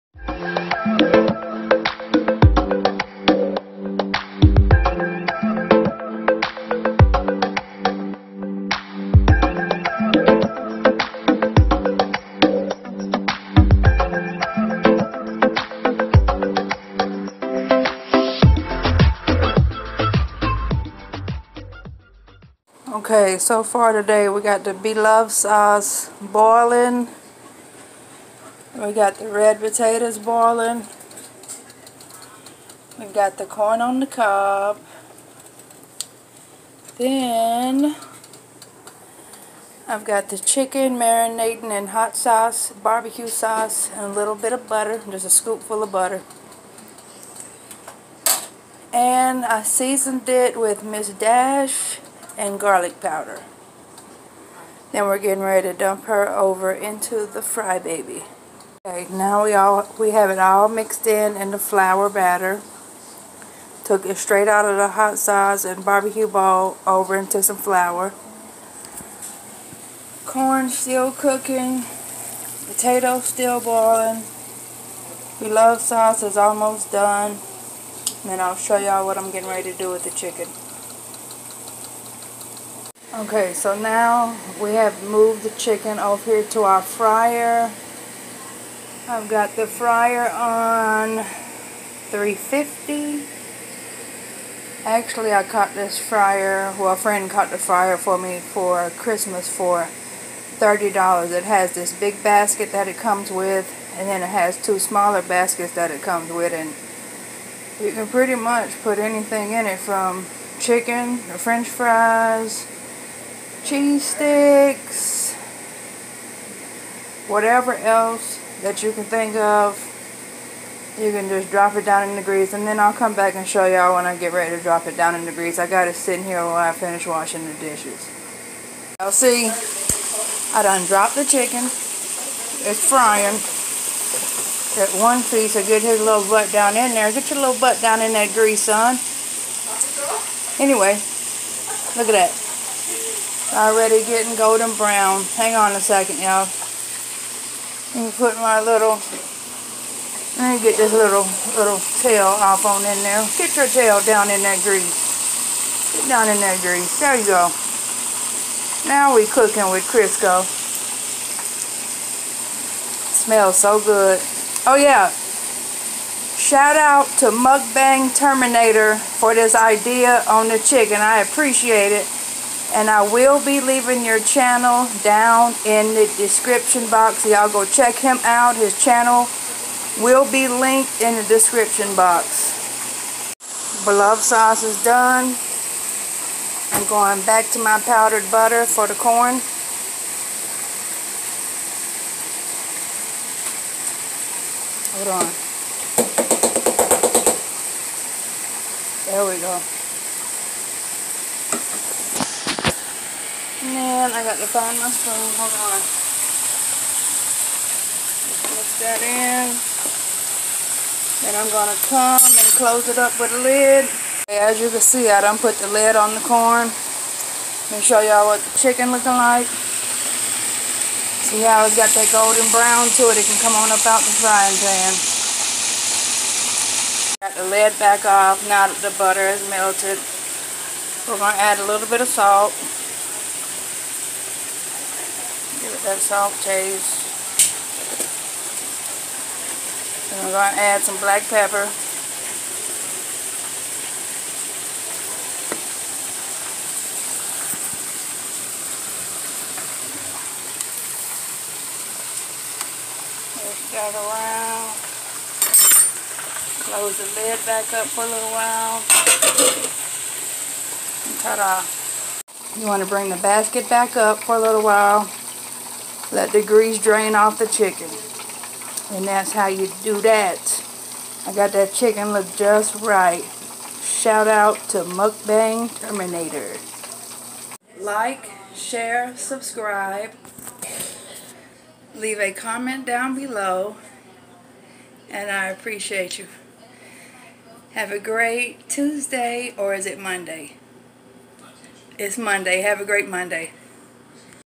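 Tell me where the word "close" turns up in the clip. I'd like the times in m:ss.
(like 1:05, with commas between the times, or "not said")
3:32, 4:16.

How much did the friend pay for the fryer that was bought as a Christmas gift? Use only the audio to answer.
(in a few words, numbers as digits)
$30.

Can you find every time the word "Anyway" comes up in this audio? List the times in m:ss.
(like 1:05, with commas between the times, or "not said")
2:20.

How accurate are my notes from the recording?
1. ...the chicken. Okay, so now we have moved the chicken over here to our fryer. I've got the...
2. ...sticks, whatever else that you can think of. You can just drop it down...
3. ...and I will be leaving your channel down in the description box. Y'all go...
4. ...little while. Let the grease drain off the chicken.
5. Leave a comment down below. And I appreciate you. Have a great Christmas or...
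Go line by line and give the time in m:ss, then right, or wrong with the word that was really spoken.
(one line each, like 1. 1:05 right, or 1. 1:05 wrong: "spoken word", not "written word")
1. 1:20 right
2. 1:54 right
3. 2:52 right
4. 4:24 right
5. 4:41 wrong: "Tuesday", not "Christmas".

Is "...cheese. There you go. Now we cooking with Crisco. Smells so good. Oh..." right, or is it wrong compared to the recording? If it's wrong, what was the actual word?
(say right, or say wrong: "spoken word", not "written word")
wrong: "grease", not "cheese".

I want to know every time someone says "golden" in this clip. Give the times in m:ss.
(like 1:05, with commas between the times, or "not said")
2:24, 3:42.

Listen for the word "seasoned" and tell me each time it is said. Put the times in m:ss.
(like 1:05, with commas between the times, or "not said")
0:49.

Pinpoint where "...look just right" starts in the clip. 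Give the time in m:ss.
4:32.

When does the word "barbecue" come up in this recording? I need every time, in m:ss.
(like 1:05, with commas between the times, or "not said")
0:42, 1:05.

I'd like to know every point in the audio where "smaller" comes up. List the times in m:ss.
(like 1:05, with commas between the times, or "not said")
1:44.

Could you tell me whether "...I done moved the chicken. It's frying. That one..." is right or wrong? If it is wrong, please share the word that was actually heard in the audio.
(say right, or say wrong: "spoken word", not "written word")
wrong: "dropped", not "moved".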